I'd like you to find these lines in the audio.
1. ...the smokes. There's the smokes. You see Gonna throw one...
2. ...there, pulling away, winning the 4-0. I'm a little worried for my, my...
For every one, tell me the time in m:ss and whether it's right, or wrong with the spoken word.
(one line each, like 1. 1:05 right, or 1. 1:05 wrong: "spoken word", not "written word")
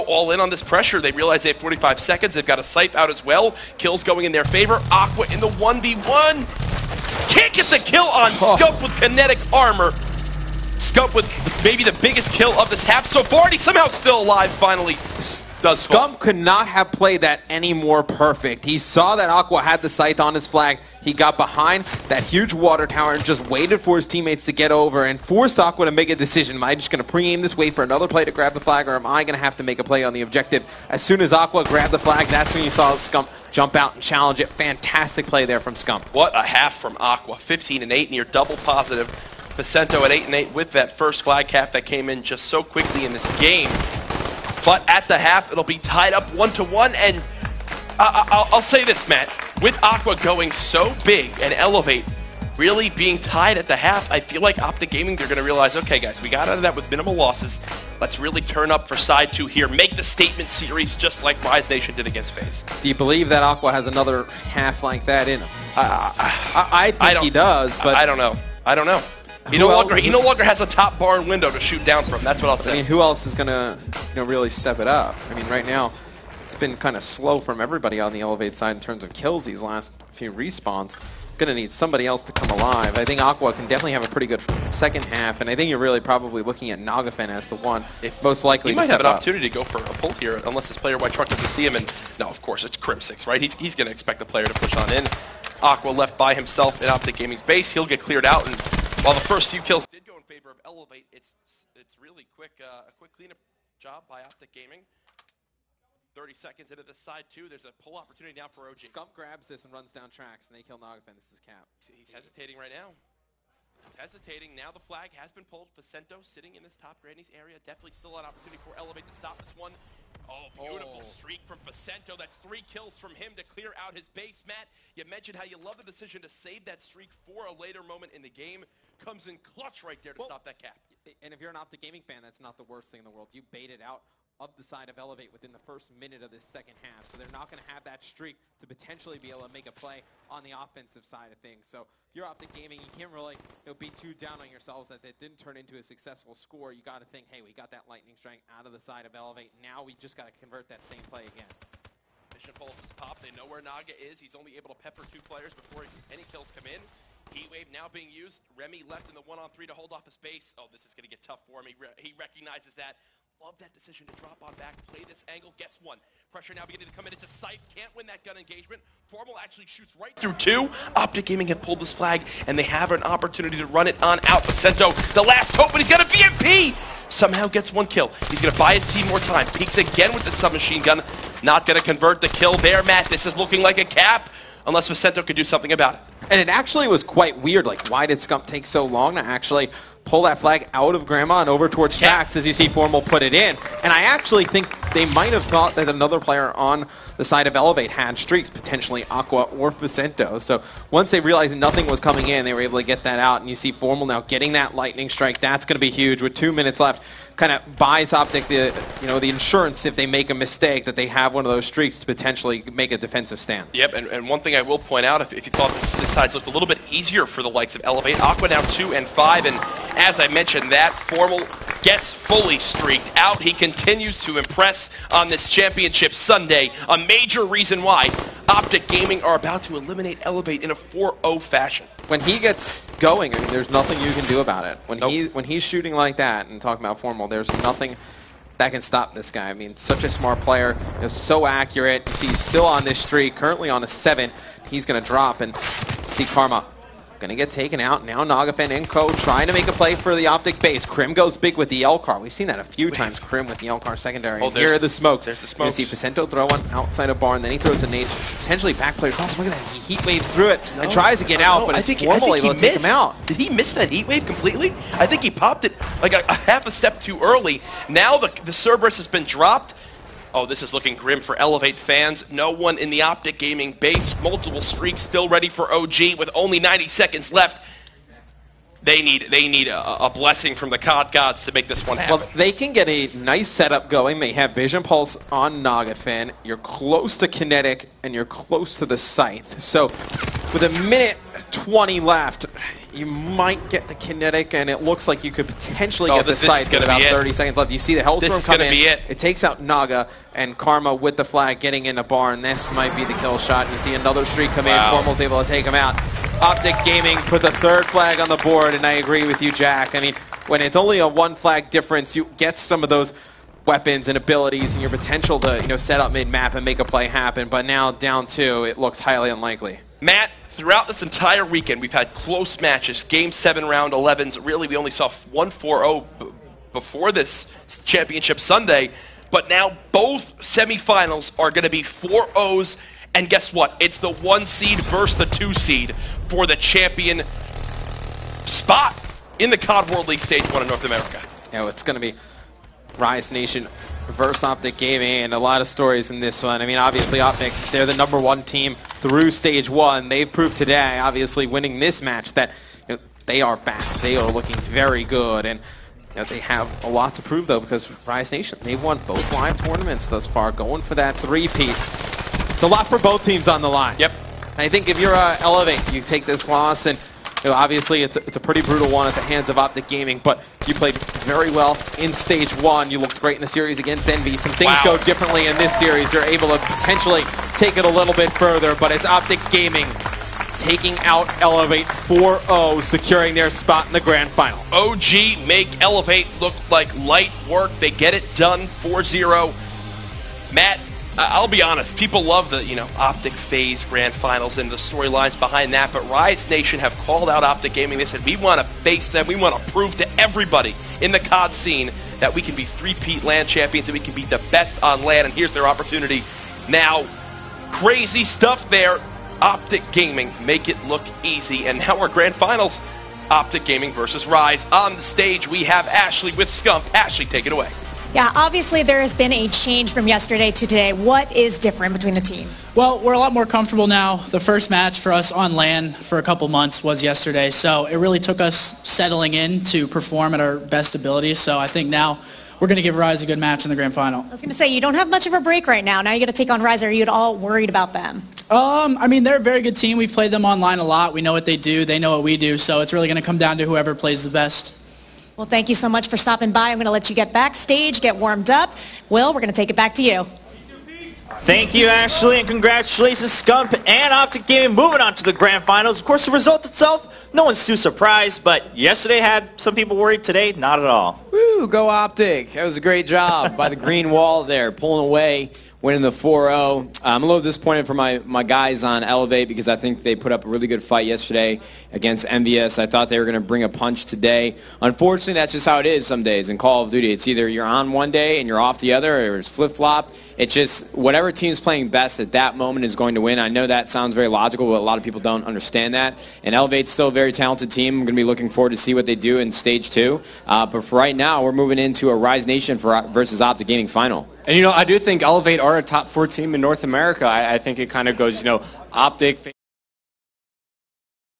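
1. 4:14 wrong: "Faccento", not "Gonna"
2. 7:44 wrong: "disappointed", not "worried".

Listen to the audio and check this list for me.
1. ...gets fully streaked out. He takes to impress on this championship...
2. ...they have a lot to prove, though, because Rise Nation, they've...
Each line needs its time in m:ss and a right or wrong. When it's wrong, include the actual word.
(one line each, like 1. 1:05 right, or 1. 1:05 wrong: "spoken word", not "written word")
1. 3:41 wrong: "continues", not "takes"
2. 5:56 right.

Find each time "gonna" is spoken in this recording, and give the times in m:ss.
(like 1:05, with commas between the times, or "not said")
1:13, 1:21, 1:33, 4:07.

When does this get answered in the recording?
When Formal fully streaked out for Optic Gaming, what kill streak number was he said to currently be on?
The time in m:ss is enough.
4:03.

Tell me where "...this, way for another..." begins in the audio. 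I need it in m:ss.
0:27.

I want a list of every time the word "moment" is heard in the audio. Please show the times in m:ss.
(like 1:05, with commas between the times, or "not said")
2:07, 8:02.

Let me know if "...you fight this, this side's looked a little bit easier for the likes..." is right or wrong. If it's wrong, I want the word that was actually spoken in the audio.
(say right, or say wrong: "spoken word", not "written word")
wrong: "thought", not "fight".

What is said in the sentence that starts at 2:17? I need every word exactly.
So they're not going to have that streak to potentially be able to make a play on the offensive side of things.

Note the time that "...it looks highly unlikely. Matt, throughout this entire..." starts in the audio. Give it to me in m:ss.
5:18.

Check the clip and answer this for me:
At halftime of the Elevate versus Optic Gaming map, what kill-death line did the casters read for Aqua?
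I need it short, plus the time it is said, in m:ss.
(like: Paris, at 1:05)
15 and 8, at 0:37.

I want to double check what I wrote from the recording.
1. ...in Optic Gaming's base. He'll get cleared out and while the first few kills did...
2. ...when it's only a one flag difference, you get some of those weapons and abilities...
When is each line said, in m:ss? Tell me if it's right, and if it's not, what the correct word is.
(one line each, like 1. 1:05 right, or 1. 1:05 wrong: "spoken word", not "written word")
1. 1:36 right
2. 5:10 right.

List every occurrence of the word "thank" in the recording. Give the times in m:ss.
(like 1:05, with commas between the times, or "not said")
7:25, 7:31.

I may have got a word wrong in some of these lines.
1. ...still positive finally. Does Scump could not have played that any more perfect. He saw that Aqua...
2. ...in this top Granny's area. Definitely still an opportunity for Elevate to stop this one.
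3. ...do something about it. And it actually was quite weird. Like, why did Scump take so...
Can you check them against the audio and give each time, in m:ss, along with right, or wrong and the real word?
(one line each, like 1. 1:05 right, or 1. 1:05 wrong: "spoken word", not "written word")
1. 0:13 wrong: "alive", not "positive"
2. 1:56 right
3. 3:05 right.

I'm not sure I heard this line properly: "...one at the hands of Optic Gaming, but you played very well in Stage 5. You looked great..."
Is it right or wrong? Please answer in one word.
wrong.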